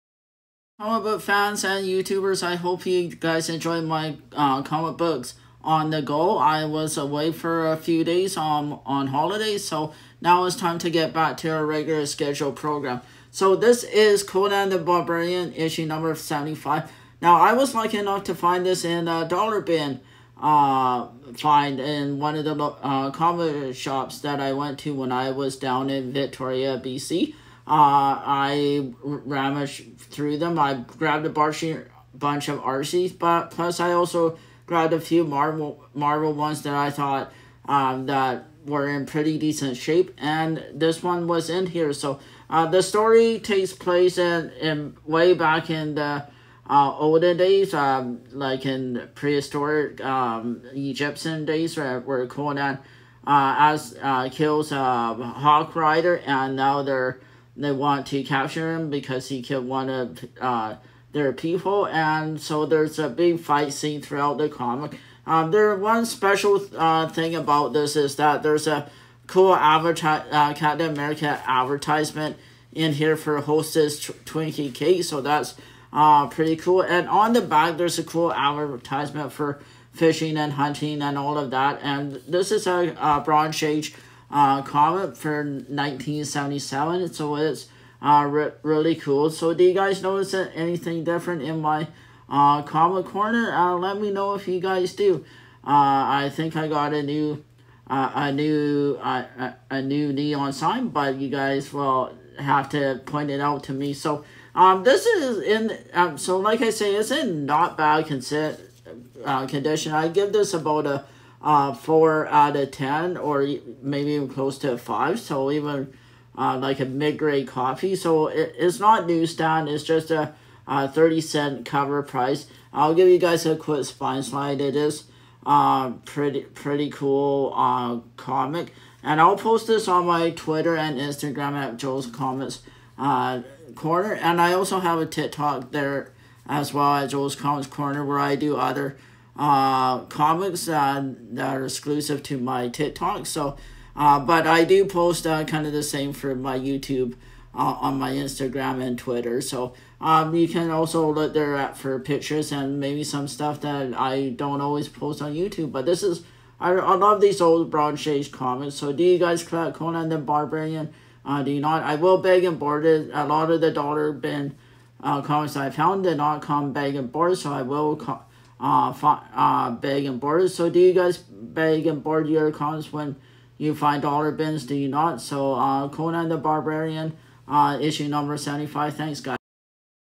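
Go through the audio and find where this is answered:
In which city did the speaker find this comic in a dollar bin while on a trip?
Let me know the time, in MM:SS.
00:26.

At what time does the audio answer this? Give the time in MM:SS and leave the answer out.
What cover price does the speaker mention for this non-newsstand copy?
02:00.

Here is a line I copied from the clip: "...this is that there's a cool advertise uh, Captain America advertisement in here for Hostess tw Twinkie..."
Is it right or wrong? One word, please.
right.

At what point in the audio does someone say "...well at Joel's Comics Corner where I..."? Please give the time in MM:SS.
02:16.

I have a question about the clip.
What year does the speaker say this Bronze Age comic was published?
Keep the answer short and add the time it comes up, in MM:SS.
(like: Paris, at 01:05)
1977, at 01:25.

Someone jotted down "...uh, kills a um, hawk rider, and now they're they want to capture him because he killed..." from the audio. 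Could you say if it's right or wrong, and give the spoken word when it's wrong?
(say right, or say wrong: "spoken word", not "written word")
right.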